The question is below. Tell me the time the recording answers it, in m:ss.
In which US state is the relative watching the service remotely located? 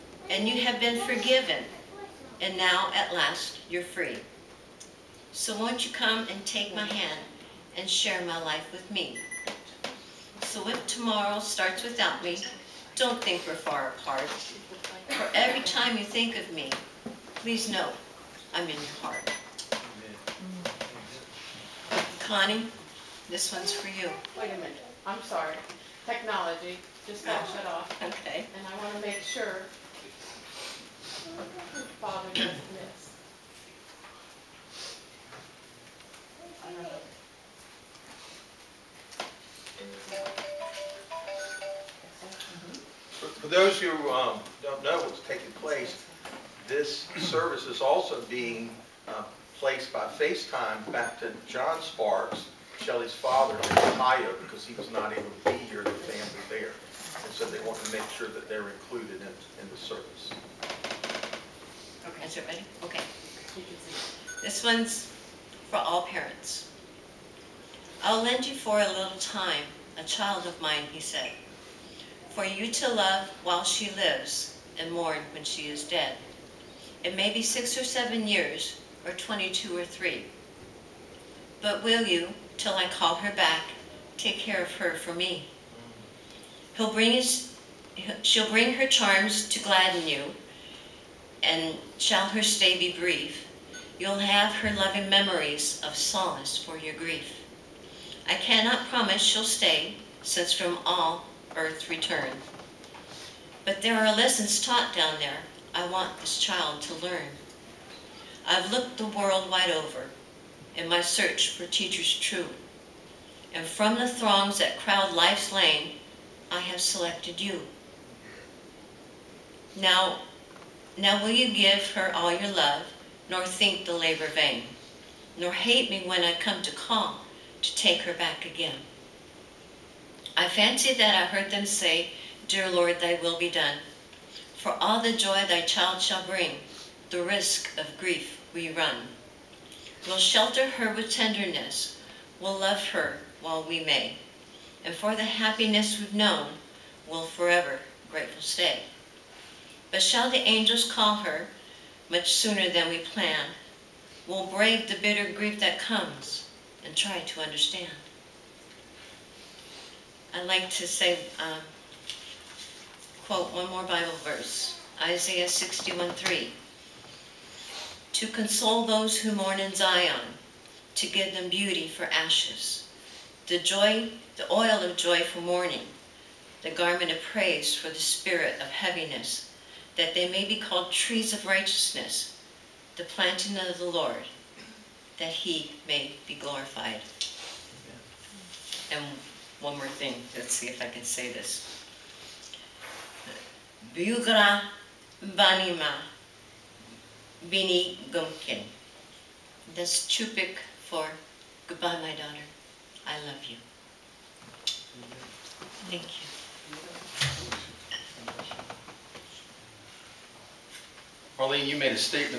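0:53.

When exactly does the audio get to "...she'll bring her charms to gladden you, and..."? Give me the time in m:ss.
1:28.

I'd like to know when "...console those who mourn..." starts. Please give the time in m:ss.
2:48.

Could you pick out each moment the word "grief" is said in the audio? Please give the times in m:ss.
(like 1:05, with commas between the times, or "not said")
1:36, 2:17, 2:35.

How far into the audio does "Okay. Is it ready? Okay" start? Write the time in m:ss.
1:02.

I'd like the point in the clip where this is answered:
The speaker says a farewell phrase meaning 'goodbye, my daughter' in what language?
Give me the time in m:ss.
3:20.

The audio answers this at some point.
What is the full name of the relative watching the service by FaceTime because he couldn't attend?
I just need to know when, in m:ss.
0:51.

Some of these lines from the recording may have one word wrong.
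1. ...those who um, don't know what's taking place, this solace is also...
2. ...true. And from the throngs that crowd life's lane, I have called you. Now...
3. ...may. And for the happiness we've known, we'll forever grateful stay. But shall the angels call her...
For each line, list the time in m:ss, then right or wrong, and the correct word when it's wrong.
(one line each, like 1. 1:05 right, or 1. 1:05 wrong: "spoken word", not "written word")
1. 0:43 wrong: "service", not "solace"
2. 1:52 wrong: "selected", not "called"
3. 2:23 right.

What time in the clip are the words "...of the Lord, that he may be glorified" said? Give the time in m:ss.
3:03.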